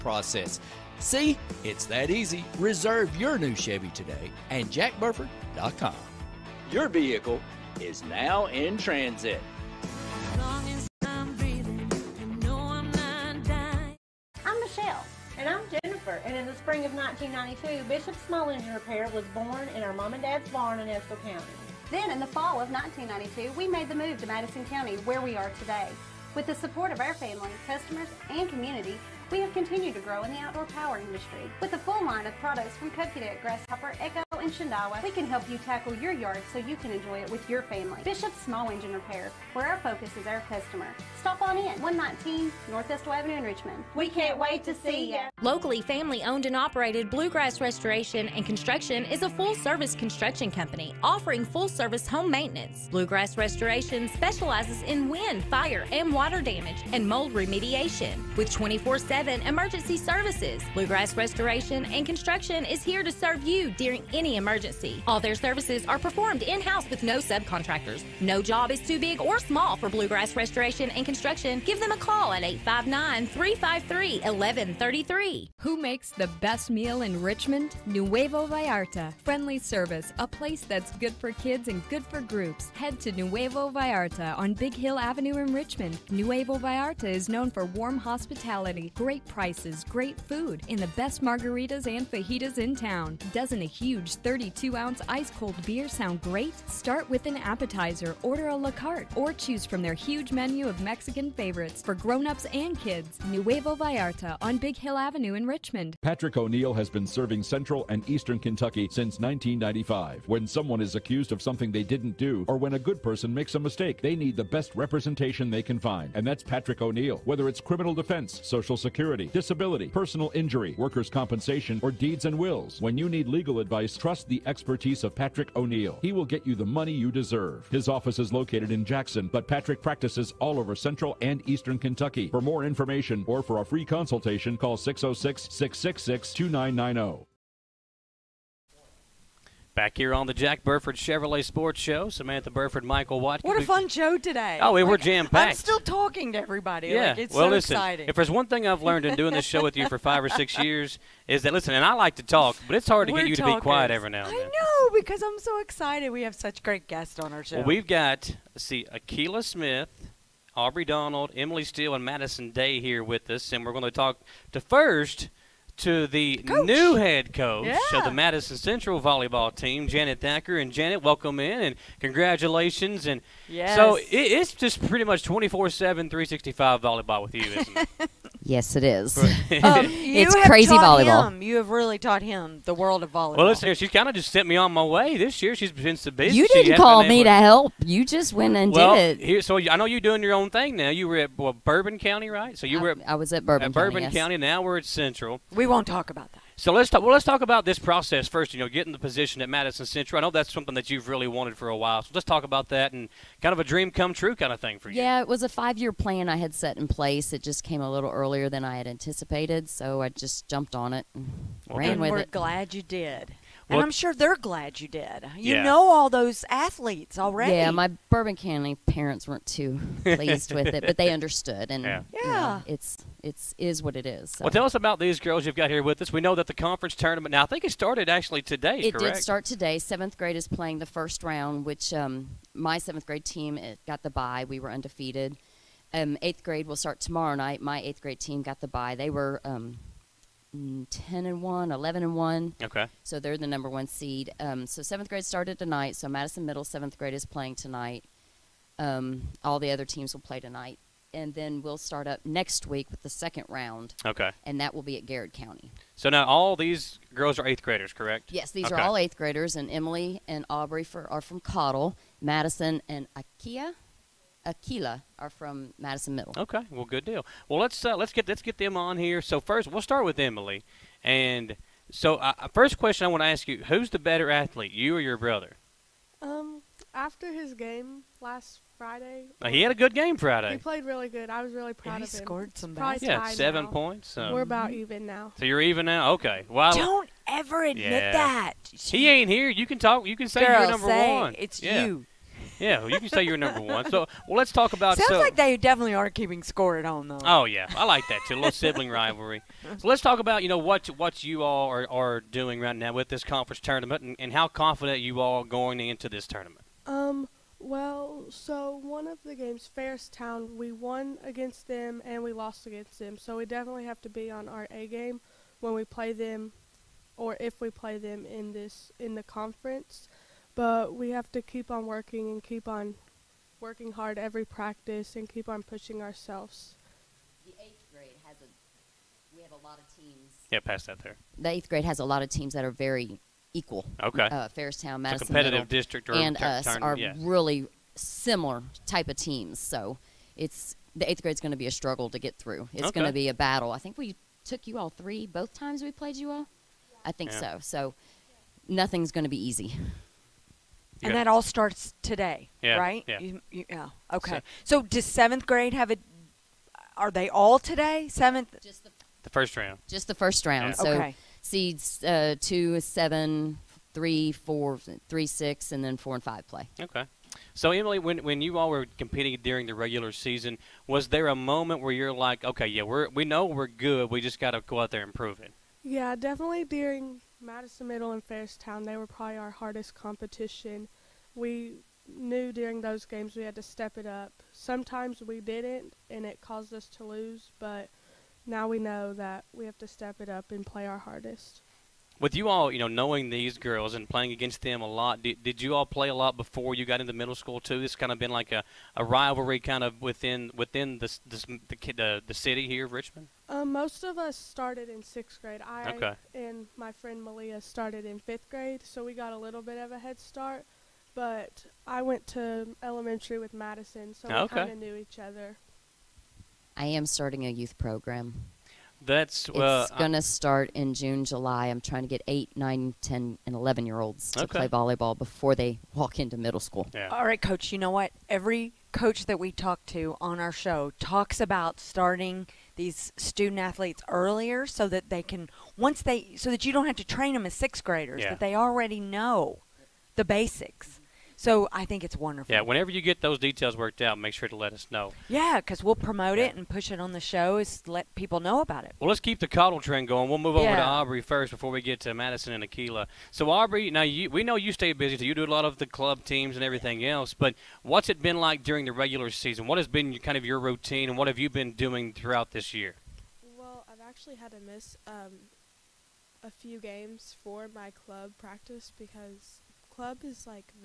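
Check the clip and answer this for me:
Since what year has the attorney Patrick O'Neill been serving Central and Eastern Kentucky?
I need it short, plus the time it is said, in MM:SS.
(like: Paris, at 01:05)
1995, at 01:49.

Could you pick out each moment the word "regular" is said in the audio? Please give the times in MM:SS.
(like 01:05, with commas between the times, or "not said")
06:09, 07:38.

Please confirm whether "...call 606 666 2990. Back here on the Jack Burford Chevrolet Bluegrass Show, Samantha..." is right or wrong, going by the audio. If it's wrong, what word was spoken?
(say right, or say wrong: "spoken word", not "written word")
wrong: "Sports", not "Bluegrass".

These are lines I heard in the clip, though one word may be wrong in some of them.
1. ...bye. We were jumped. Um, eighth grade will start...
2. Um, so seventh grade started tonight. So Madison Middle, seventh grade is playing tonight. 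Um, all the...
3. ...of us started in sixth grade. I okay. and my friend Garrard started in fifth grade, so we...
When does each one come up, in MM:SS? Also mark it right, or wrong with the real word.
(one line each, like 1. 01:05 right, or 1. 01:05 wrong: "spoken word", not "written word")
1. 03:54 wrong: "undefeated", not "jumped"
2. 04:04 right
3. 06:44 wrong: "Malia", not "Garrard".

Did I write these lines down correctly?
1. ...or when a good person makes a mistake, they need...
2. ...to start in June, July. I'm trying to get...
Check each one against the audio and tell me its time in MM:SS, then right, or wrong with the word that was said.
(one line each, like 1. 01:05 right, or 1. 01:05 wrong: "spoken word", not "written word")
1. 01:52 right
2. 07:00 right.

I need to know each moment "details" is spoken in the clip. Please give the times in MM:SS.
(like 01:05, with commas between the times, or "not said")
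07:23.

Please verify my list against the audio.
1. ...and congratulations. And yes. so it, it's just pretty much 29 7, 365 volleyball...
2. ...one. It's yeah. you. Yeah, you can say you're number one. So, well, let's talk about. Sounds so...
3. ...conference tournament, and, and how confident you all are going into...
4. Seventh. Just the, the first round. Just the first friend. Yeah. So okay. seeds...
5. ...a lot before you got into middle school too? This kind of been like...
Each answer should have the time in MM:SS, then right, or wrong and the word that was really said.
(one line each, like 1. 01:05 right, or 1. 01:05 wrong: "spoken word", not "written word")
1. 02:51 wrong: "24", not "29"
2. 04:51 right
3. 05:03 right
4. 05:58 wrong: "round", not "friend"
5. 06:36 right.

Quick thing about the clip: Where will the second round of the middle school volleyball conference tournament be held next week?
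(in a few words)
Garrard County.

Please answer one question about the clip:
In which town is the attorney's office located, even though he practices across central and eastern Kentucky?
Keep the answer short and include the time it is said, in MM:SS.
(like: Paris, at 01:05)
Jackson, at 02:08.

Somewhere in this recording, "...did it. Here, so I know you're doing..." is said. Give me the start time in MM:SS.
03:08.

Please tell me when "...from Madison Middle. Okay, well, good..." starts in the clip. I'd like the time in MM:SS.
04:25.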